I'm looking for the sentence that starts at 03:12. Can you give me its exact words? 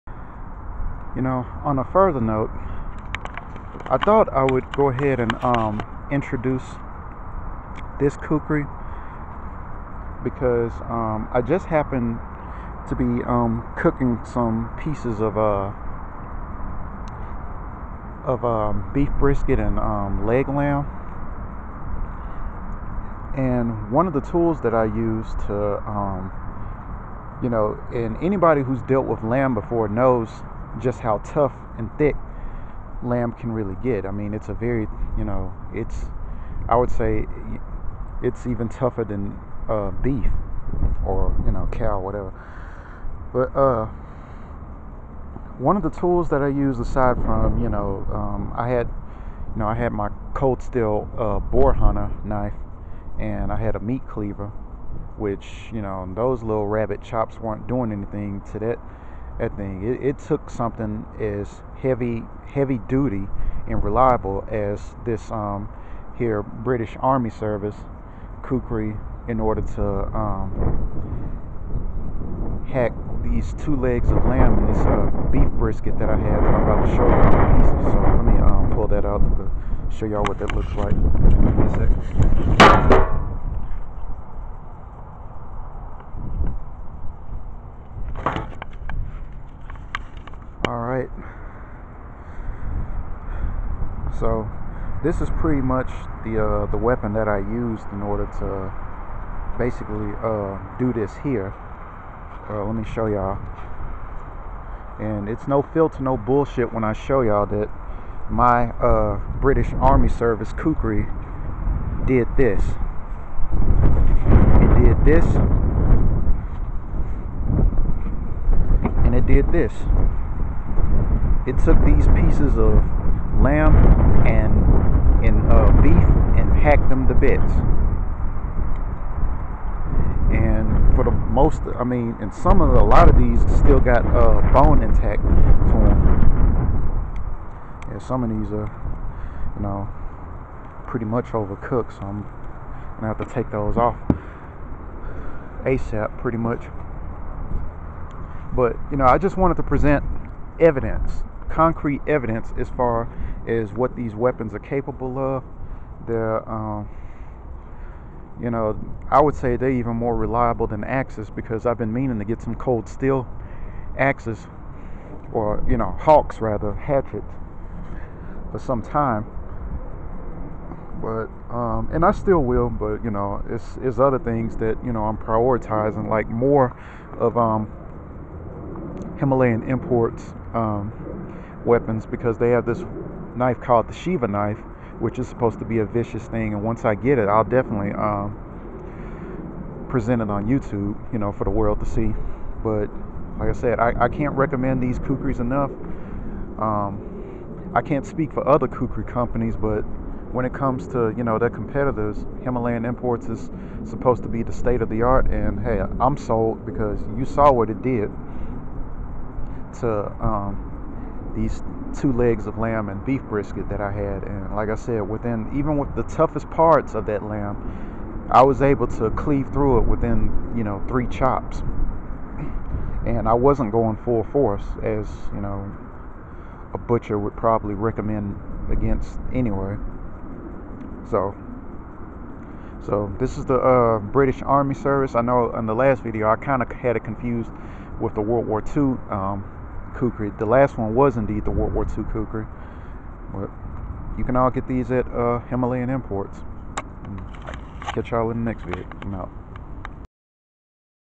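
But like I said, I, I can't recommend these kukris enough.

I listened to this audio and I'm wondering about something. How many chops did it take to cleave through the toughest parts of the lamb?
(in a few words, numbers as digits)
3.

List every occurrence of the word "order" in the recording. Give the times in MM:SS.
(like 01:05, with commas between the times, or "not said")
01:09, 01:38.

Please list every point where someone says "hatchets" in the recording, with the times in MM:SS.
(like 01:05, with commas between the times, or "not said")
02:46.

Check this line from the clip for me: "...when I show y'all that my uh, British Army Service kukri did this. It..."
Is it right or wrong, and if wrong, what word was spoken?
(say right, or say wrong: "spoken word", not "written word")
right.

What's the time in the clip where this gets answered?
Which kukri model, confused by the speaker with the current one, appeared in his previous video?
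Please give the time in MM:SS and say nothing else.
04:01.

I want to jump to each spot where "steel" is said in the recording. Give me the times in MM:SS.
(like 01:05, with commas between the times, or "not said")
00:50, 02:42.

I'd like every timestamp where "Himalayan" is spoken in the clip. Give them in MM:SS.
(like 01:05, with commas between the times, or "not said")
02:59, 03:22, 04:05.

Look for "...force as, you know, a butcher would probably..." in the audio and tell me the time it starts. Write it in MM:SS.
03:44.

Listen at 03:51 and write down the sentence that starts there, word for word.
So so this is the uh, British Army Service.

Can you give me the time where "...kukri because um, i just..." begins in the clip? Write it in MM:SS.
00:08.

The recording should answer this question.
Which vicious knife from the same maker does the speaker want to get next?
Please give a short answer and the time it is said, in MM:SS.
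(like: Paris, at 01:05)
Shiva knife, at 03:03.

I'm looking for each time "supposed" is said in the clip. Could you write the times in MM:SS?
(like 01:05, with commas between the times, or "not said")
03:05, 03:23.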